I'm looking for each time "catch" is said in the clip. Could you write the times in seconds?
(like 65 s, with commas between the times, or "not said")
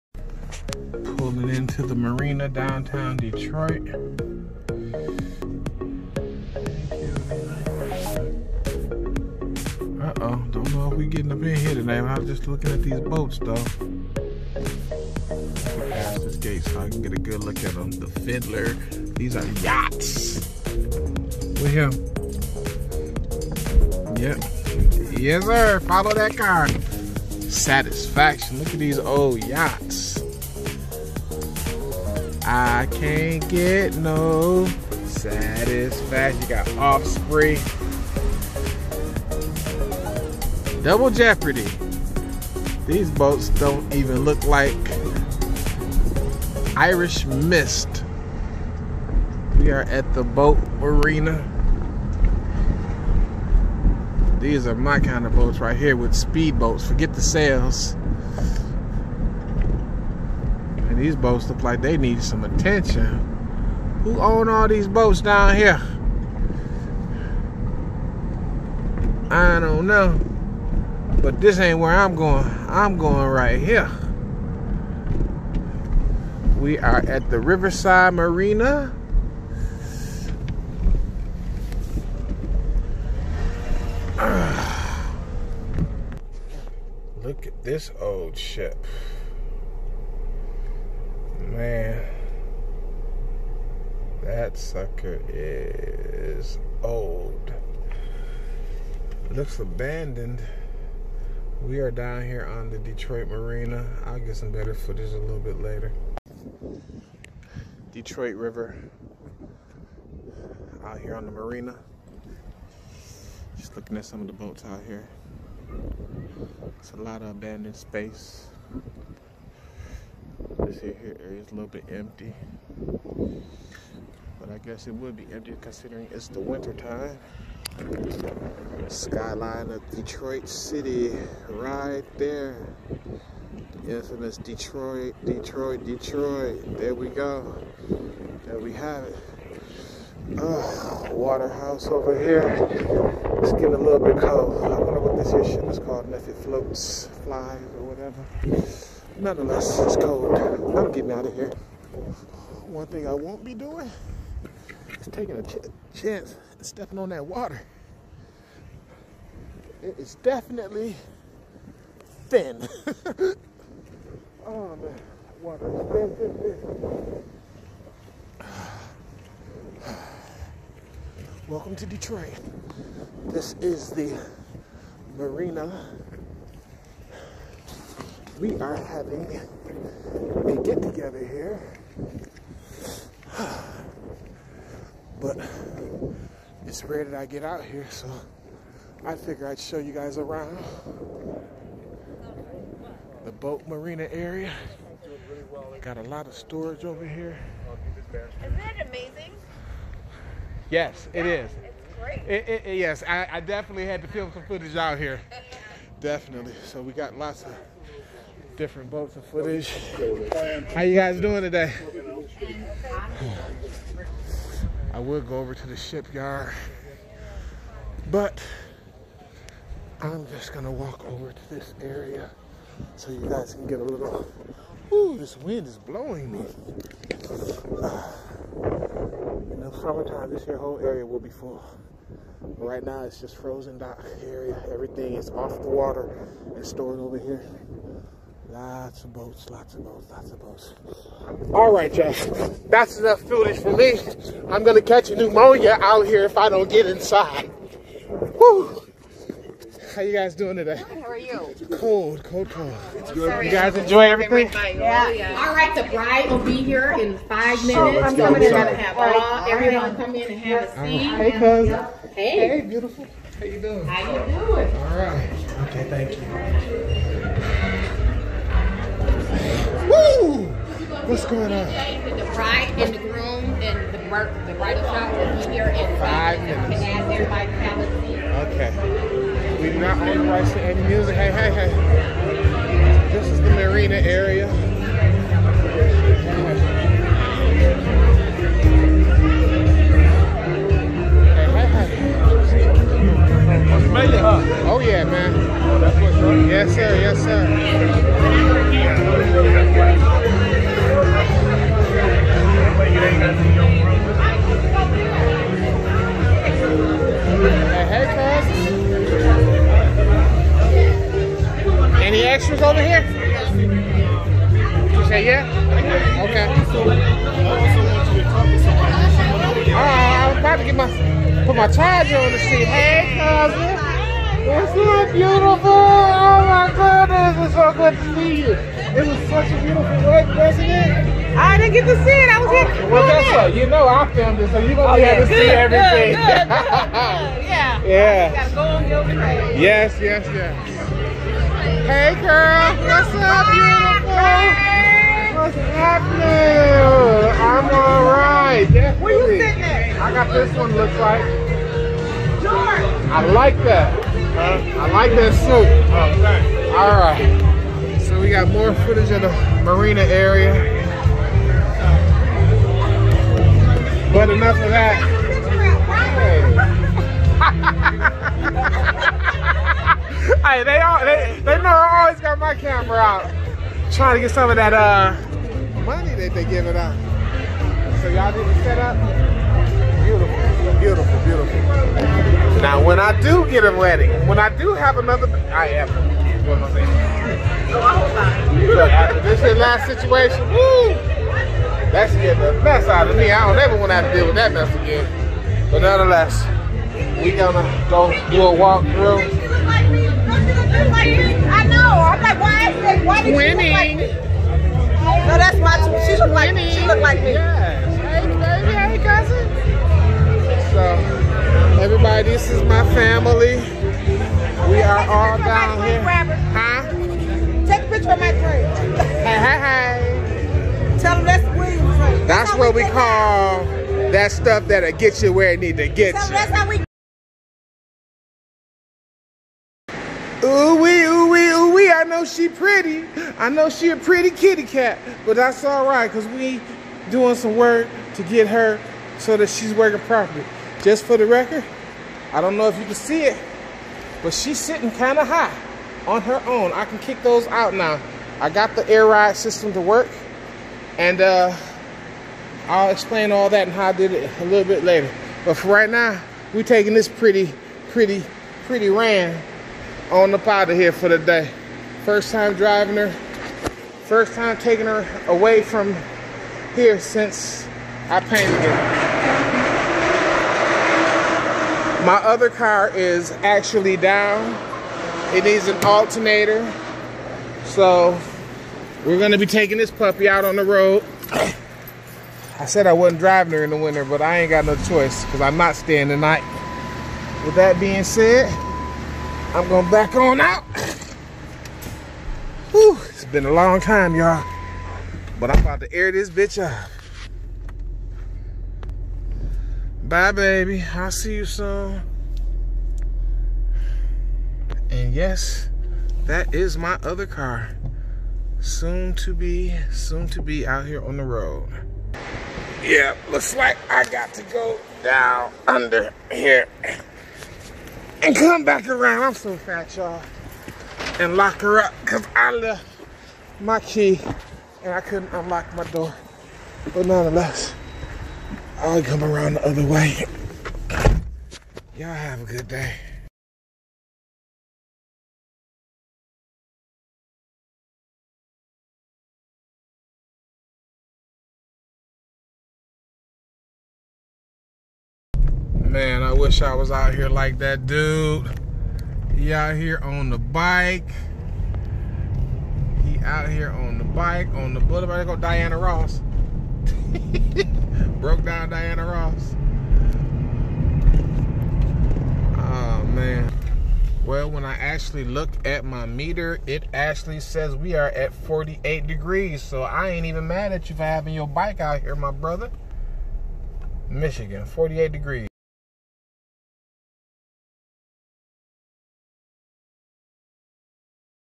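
244 s.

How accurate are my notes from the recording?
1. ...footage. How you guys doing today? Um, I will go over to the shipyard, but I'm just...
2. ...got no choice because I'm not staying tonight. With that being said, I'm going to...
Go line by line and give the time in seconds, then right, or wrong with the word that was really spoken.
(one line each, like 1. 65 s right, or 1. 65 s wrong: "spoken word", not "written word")
1. 209 s right
2. 484 s right.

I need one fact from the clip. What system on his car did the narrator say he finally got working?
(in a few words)
air ride system.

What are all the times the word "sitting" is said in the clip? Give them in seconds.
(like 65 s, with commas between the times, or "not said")
349 s, 444 s.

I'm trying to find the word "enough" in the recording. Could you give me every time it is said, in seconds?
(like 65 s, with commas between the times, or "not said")
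242 s, 364 s.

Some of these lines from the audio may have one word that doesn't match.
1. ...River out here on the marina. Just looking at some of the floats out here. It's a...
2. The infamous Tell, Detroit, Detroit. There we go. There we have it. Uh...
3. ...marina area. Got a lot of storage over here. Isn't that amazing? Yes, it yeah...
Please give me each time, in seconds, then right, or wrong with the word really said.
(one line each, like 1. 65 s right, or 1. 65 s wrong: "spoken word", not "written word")
1. 108 s wrong: "boats", not "floats"
2. 133 s wrong: "Detroit", not "Tell"
3. 193 s right.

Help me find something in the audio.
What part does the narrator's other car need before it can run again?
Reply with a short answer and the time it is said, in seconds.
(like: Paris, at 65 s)
alternator, at 475 s.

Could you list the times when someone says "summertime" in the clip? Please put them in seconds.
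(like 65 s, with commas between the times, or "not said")
229 s.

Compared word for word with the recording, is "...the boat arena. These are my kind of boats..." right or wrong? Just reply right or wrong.
right.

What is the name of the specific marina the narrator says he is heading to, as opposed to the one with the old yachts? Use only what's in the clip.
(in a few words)
Riverside Marina.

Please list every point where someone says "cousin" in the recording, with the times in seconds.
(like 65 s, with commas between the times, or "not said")
261 s, 323 s.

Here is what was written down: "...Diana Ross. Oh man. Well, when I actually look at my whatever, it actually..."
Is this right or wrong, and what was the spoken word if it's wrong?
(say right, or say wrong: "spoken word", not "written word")
wrong: "meter", not "whatever".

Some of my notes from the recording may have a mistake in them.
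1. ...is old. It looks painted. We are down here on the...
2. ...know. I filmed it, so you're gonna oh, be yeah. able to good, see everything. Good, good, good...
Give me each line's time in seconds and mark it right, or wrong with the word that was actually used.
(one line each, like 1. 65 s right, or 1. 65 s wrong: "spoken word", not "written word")
1. 95 s wrong: "abandoned", not "painted"
2. 333 s right.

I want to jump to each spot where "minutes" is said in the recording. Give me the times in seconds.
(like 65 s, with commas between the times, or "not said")
257 s, 276 s.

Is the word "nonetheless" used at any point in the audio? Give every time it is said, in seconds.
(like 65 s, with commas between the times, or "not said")
149 s, 395 s, 527 s.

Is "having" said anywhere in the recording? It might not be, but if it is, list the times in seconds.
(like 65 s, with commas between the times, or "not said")
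178 s, 571 s.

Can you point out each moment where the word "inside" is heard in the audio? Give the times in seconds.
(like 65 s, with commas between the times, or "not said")
246 s.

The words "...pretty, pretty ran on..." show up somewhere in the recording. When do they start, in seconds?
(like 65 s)
457 s.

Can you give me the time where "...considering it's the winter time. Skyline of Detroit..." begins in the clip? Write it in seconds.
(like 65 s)
125 s.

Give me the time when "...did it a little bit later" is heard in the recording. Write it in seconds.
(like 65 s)
453 s.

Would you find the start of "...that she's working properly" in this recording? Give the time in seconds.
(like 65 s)
439 s.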